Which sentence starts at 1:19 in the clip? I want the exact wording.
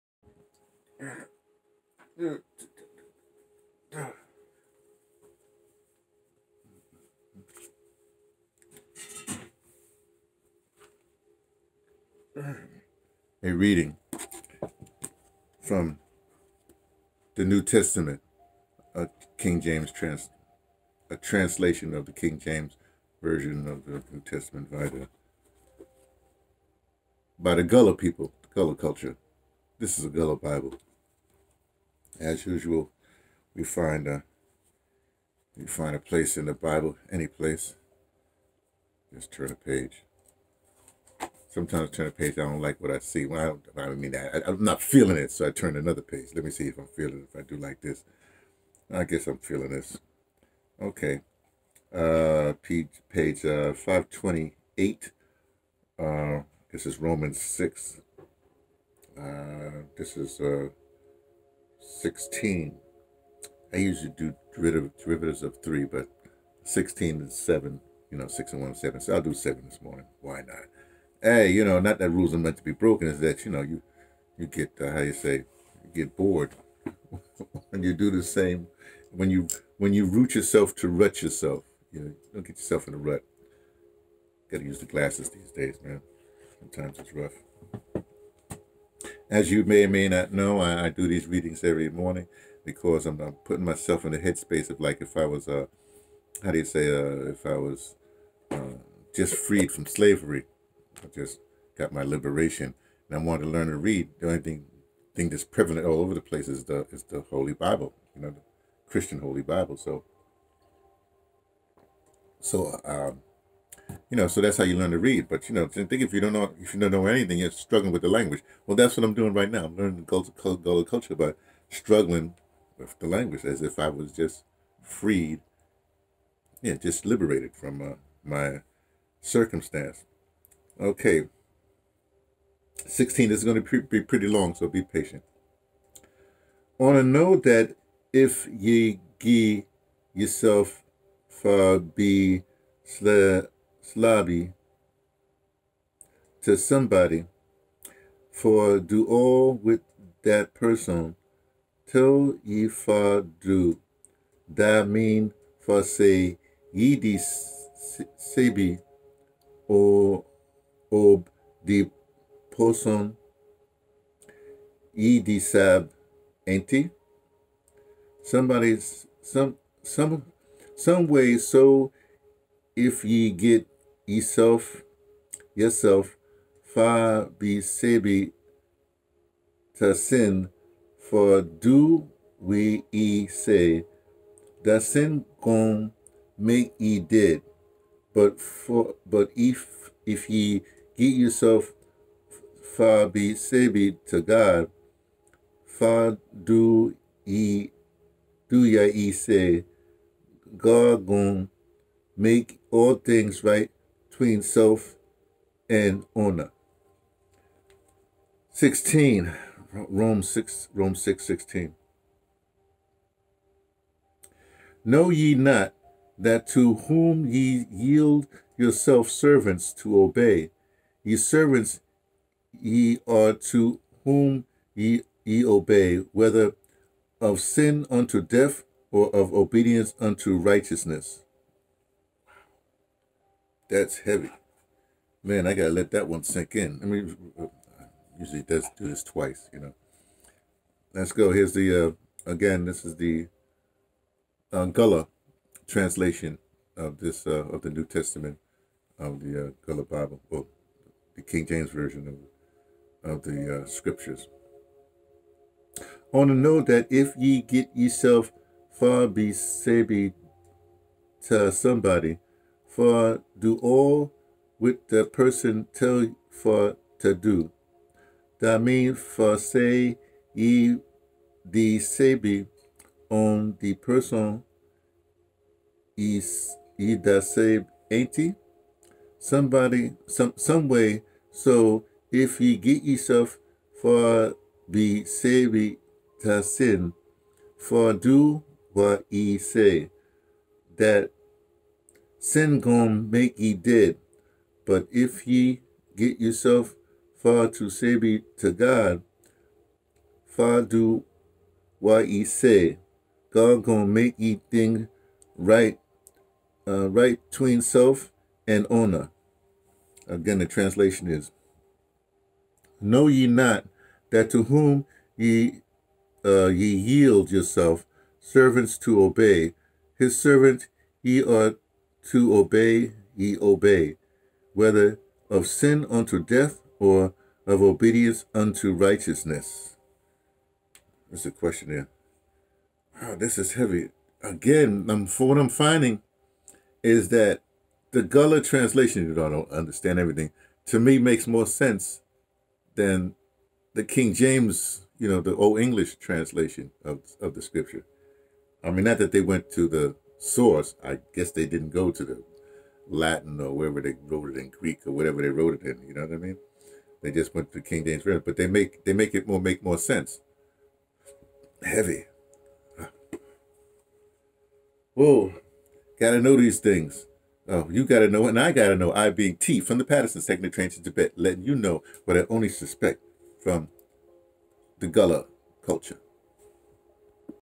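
When you when you root yourself to rut yourself, you know, don't get yourself in a rut.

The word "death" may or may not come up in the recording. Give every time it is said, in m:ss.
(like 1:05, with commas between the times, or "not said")
3:48, 5:26.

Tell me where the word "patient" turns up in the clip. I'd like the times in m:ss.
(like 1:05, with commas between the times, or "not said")
2:14.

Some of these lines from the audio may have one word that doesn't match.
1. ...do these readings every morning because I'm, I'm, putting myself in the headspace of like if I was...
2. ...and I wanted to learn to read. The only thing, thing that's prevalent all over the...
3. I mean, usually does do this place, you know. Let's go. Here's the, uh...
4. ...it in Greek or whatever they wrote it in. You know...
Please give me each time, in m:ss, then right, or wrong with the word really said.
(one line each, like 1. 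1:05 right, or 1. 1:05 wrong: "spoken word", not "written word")
1. 1:30 right
2. 1:43 right
3. 3:56 wrong: "twice", not "place"
4. 5:54 right.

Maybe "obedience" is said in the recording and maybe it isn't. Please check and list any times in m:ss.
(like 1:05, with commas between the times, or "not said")
3:49, 5:27.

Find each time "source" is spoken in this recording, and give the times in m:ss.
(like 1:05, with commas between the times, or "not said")
5:50.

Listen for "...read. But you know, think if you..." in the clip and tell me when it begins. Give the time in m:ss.
1:54.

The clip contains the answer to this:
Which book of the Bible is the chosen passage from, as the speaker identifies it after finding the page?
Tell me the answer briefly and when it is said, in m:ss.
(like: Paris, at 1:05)
Romans, at 0:56.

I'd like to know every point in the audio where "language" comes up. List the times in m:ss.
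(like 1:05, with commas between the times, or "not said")
1:58, 2:03.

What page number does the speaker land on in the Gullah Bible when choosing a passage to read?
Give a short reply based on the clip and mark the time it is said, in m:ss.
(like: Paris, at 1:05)
528, at 0:53.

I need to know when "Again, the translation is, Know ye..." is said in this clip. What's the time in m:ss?
5:10.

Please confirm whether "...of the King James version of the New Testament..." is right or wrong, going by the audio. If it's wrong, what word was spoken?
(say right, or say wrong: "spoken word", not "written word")
right.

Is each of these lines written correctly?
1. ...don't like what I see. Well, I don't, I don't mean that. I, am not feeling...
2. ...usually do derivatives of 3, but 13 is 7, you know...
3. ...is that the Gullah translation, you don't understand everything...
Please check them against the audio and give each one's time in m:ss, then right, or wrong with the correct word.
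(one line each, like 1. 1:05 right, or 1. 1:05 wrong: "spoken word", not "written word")
1. 0:42 right
2. 1:03 wrong: "16", not "13"
3. 5:36 right.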